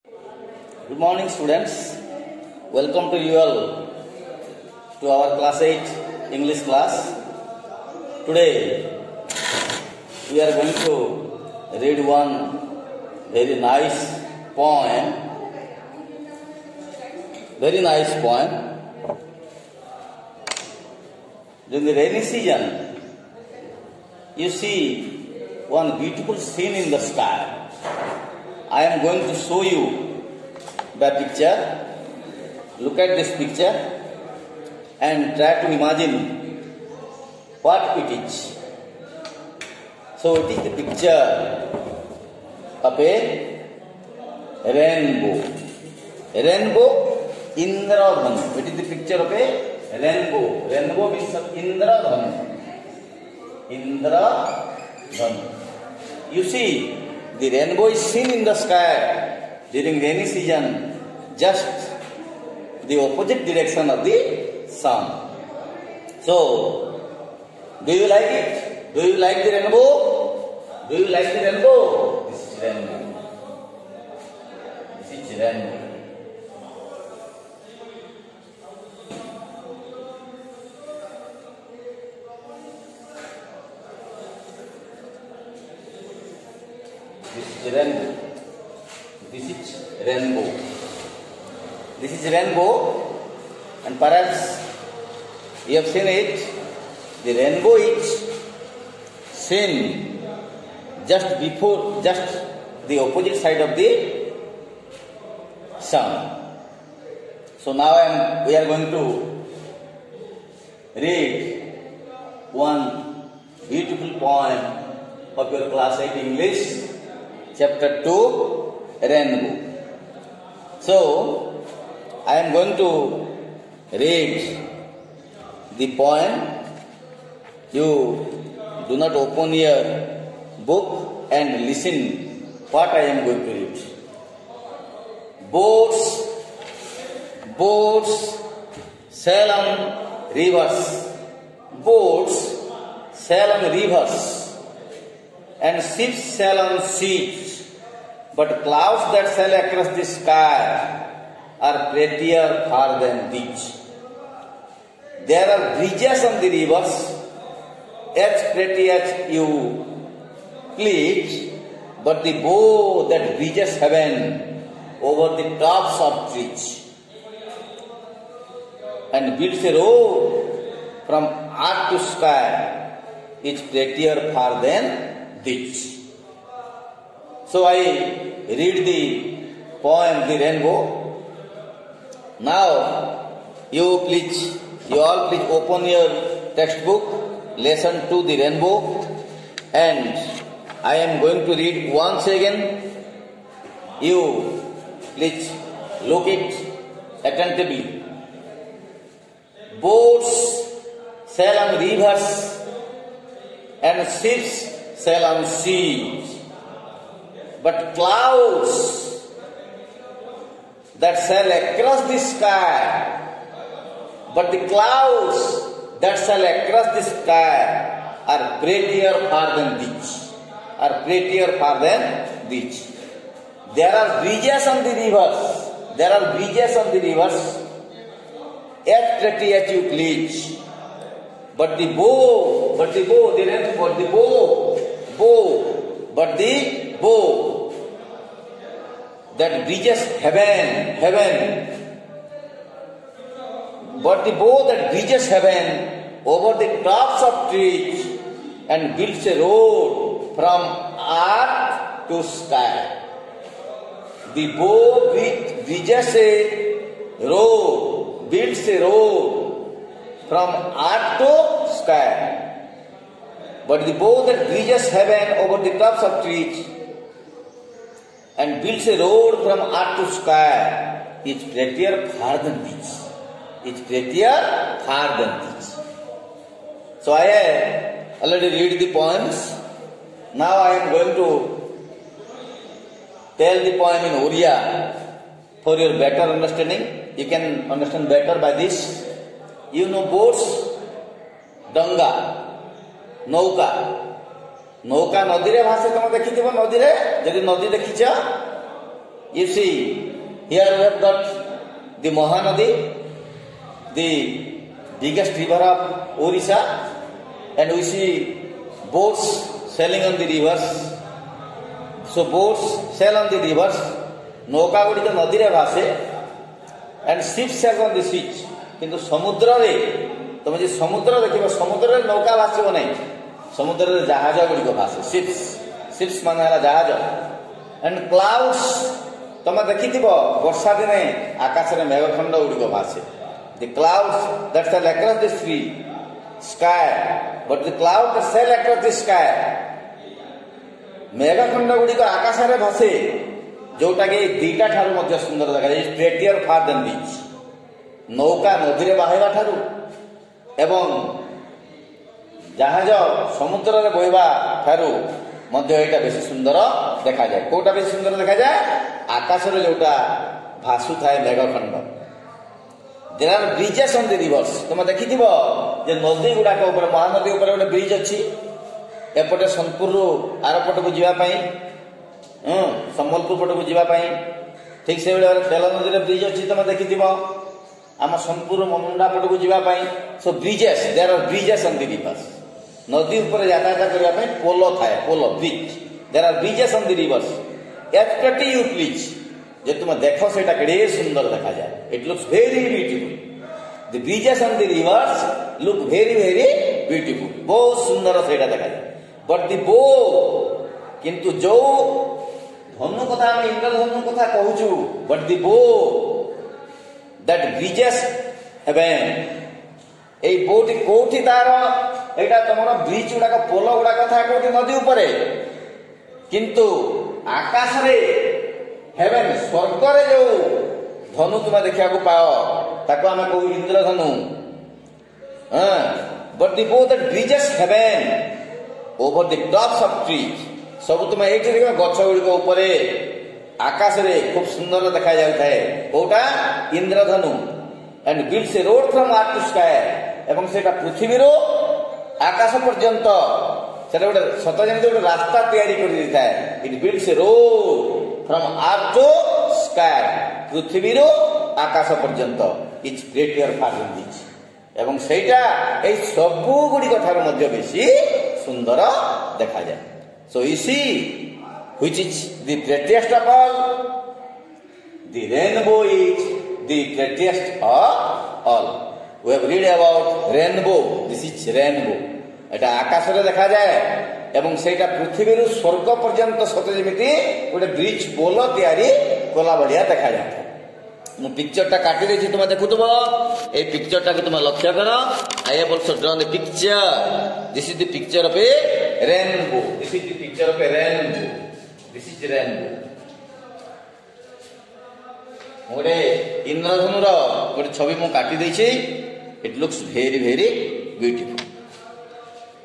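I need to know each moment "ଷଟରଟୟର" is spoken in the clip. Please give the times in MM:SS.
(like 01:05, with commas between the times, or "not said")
05:45.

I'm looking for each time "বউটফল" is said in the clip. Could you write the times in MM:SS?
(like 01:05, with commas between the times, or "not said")
06:32, 06:36.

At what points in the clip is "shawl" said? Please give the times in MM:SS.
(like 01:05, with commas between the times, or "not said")
not said.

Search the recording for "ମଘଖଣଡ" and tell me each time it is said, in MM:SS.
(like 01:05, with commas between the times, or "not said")
05:31, 05:41, 06:01.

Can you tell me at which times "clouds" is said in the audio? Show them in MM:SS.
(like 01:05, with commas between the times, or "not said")
02:28, 03:27, 03:34, 05:33, 05:37.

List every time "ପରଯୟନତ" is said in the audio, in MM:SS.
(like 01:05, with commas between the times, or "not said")
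07:22, 07:56.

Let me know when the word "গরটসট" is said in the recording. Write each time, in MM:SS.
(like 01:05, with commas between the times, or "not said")
07:42, 07:46.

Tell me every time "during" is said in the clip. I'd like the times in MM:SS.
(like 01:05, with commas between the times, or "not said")
00:21, 00:59.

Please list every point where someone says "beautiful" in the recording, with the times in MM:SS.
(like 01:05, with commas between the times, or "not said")
00:26, 01:53.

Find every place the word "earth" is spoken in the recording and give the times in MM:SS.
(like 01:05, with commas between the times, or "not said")
02:51, 04:11, 04:20, 04:29.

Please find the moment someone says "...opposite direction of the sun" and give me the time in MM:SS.
01:02.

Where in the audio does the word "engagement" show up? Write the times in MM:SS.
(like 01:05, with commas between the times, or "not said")
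not said.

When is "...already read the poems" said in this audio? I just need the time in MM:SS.
04:38.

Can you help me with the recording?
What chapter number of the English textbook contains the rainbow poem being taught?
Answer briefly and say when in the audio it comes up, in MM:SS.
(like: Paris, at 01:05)
2, at 01:57.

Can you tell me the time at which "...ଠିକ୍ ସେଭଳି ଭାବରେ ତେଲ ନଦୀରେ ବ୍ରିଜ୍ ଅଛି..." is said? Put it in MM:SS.
06:14.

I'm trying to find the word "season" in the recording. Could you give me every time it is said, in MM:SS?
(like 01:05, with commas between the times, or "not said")
00:22, 01:00.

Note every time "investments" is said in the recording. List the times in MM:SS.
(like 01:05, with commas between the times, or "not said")
not said.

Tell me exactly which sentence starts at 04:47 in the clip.
You can understand better by this.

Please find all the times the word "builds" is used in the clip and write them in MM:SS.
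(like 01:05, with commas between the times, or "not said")
02:49, 04:08, 04:18, 04:28.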